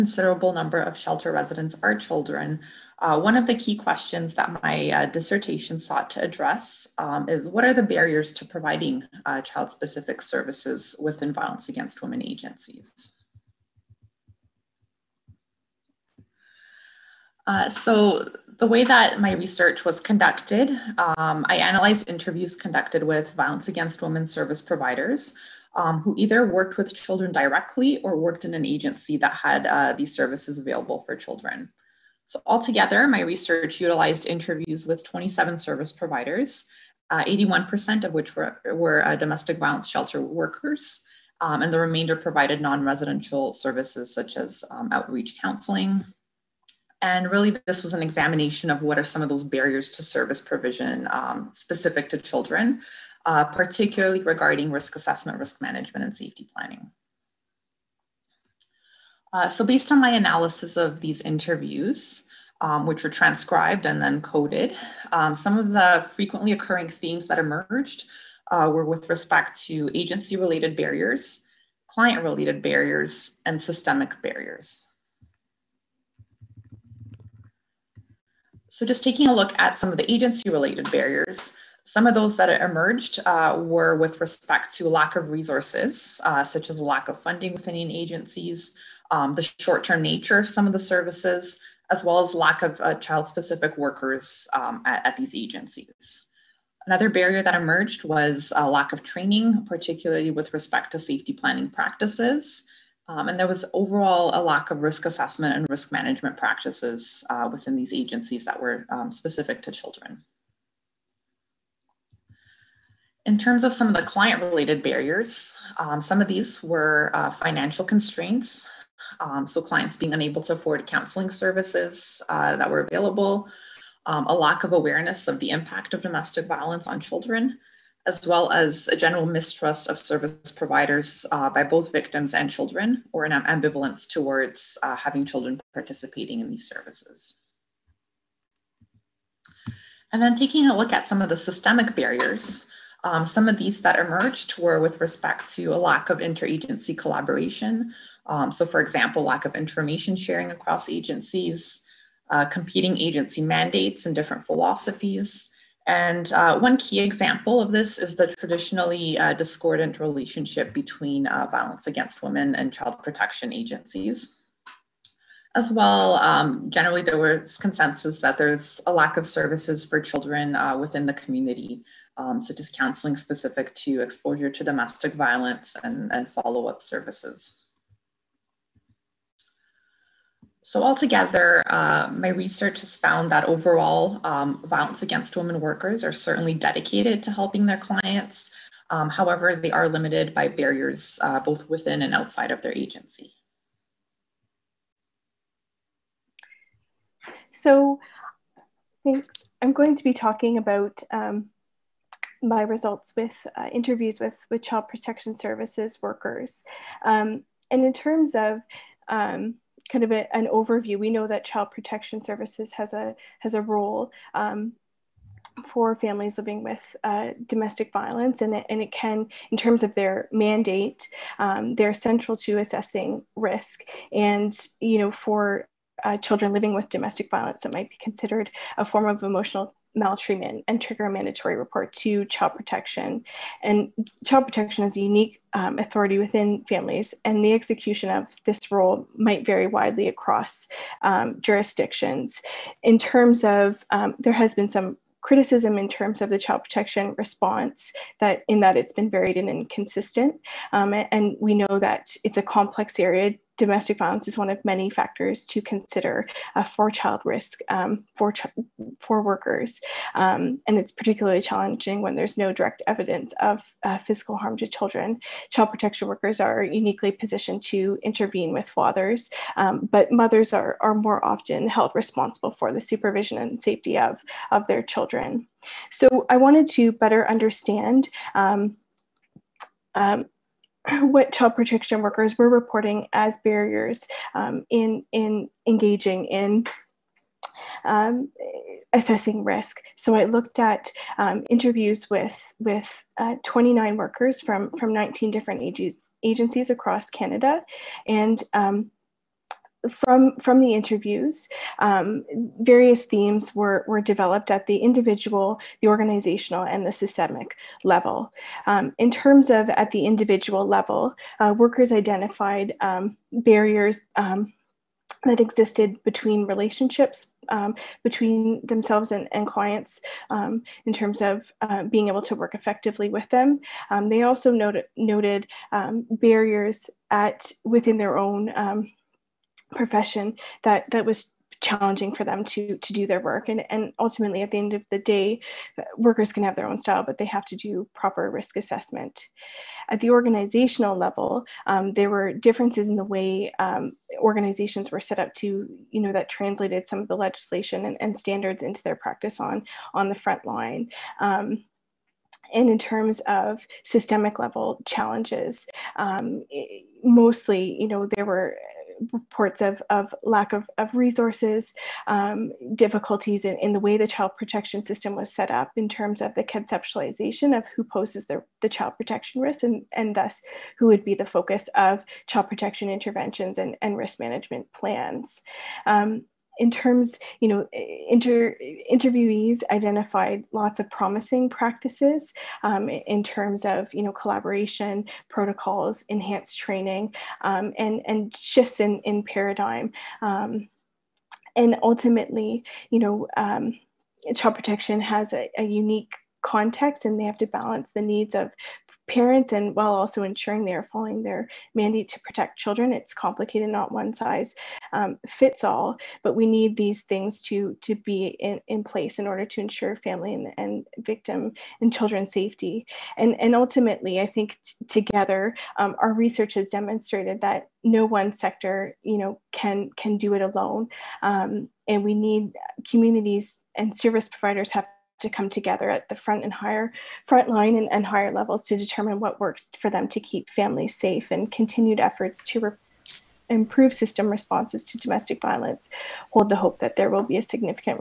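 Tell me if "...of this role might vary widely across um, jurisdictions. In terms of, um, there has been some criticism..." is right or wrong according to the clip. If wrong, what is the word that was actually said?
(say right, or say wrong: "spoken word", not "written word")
right.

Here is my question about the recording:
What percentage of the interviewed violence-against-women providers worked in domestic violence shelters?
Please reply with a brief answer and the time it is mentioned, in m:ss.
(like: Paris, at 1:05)
81%, at 0:37.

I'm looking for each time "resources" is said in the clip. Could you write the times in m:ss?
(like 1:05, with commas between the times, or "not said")
1:25, 6:00.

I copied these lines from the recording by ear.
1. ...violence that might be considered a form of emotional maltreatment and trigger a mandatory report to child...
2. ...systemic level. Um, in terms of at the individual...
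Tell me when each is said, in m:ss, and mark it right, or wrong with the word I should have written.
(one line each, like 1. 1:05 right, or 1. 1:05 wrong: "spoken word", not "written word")
1. 3:47 right
2. 5:06 right.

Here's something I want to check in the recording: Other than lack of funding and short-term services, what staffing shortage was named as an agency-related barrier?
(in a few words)
child specific workers.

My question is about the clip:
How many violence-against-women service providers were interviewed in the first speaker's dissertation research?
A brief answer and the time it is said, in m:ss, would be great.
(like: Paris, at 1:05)
27, at 0:35.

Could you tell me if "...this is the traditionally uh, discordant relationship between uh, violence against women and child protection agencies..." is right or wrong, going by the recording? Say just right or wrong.
right.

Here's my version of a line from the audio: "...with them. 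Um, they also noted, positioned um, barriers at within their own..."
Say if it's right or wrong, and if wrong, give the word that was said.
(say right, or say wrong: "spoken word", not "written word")
wrong: "noted", not "positioned".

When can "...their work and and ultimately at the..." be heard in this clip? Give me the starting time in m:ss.
5:33.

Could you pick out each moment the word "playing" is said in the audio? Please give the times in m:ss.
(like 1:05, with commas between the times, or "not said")
not said.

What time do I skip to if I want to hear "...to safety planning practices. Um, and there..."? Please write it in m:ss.
1:40.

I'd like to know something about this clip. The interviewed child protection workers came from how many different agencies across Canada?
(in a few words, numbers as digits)
19.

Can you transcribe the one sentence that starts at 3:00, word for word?
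So altogether, uh, my research has found that overall, um, violence against women workers are certainly dedicated to helping their clients.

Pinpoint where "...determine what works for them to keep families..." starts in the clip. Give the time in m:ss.
7:08.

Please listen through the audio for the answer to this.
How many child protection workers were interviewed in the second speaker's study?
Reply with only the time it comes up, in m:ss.
4:53.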